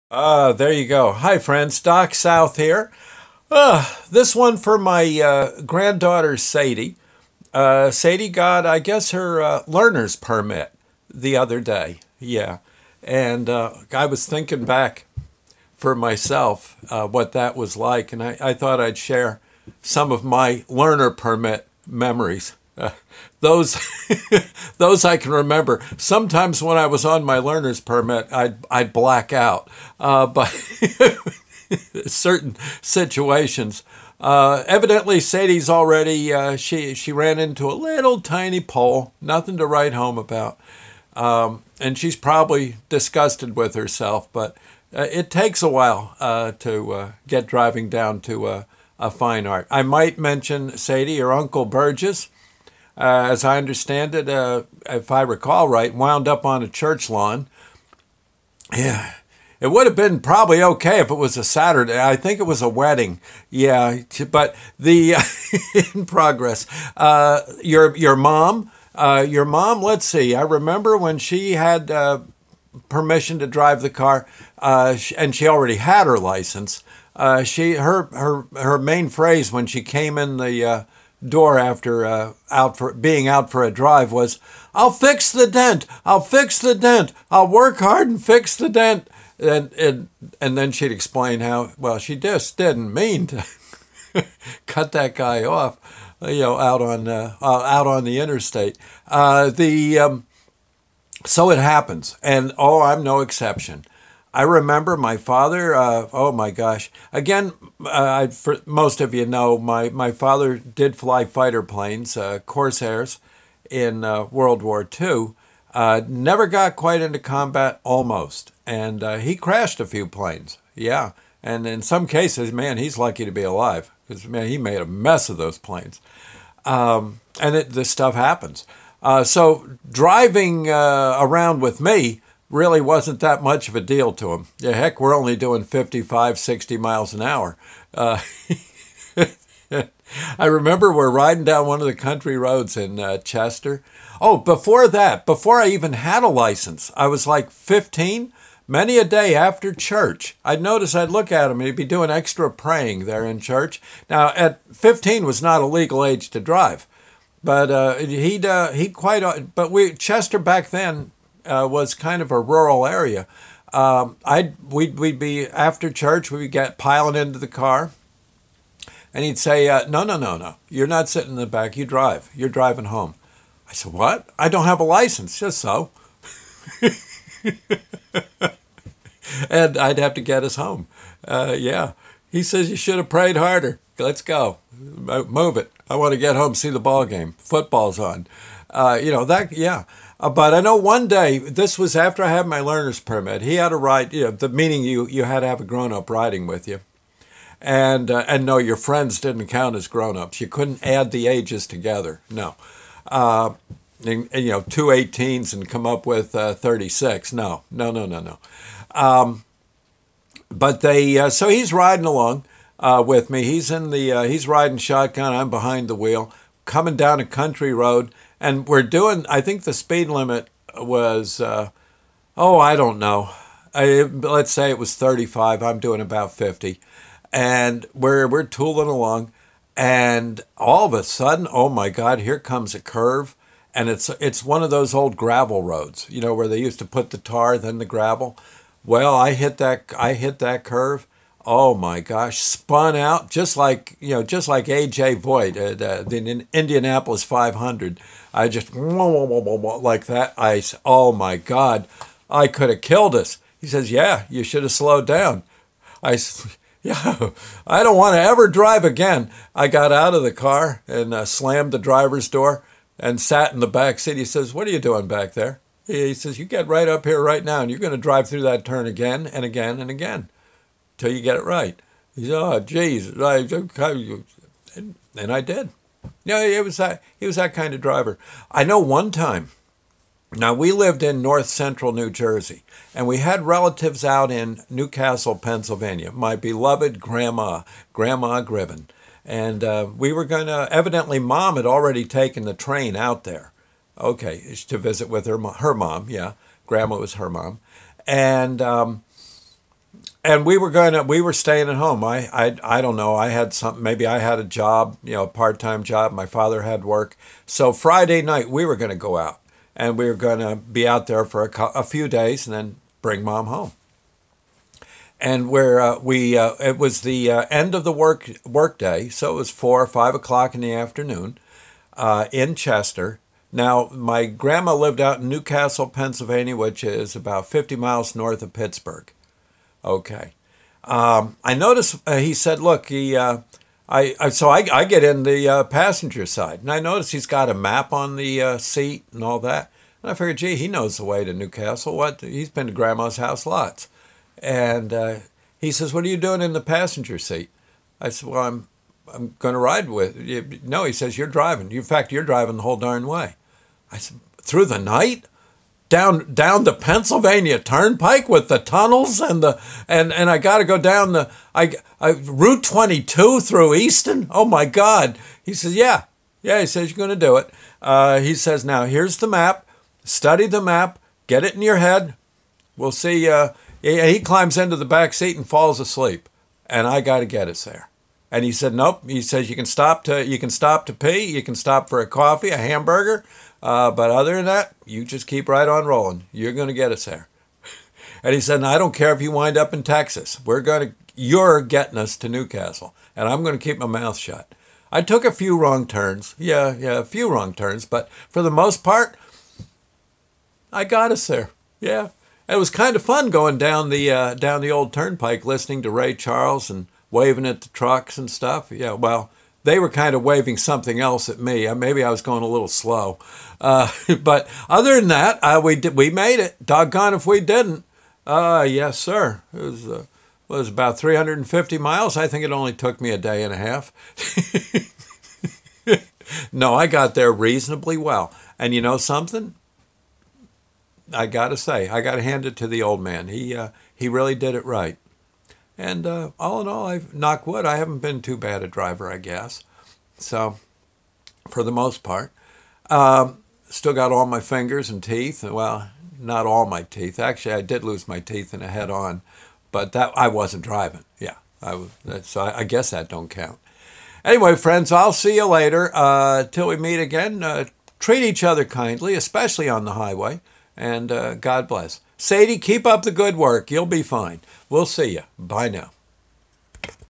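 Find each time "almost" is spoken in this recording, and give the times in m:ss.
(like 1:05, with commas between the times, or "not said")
1:57.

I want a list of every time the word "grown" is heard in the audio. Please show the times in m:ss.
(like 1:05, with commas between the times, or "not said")
3:15, 3:19.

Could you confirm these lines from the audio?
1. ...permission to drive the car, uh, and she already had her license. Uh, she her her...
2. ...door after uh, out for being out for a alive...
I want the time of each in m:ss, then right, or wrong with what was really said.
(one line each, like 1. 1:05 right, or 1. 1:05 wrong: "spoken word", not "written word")
1. 1:12 right
2. 1:21 wrong: "drive", not "alive".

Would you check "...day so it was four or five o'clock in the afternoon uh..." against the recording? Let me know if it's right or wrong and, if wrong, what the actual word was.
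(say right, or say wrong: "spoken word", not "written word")
right.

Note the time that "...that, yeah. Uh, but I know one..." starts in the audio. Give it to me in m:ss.
3:09.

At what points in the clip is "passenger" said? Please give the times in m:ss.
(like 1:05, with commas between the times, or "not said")
5:35, 5:46.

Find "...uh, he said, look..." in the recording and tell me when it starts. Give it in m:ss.
5:32.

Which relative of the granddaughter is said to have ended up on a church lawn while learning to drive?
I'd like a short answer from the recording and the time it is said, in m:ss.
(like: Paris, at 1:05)
Uncle Burgess, at 0:51.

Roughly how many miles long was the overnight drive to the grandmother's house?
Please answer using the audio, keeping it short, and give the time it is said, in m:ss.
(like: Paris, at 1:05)
350, at 7:00.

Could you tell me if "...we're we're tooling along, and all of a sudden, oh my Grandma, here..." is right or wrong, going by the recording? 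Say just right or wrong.
wrong.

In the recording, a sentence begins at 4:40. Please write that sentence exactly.
Now we lived in north central New Jersey, and we had relatives out in Newcastle, Pennsylvania.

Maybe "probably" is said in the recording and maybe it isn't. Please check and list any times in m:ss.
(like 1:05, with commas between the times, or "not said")
0:42, 1:00.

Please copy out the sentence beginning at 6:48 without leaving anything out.
Yeah, well, they were kind of waving something else at me.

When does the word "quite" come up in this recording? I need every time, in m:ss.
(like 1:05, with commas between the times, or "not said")
1:56, 2:38.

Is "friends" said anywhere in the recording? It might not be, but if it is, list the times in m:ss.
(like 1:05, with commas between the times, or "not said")
0:01, 3:18, 7:34.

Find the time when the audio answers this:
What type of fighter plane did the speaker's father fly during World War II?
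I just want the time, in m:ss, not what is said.
1:52.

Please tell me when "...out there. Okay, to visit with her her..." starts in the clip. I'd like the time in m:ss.
4:52.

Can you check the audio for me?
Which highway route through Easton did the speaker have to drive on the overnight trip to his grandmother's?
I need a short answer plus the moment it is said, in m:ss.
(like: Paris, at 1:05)
Route 22, at 6:02.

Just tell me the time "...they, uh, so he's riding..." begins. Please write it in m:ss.
3:30.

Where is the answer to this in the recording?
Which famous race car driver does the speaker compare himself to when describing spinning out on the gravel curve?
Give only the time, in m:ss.
4:04.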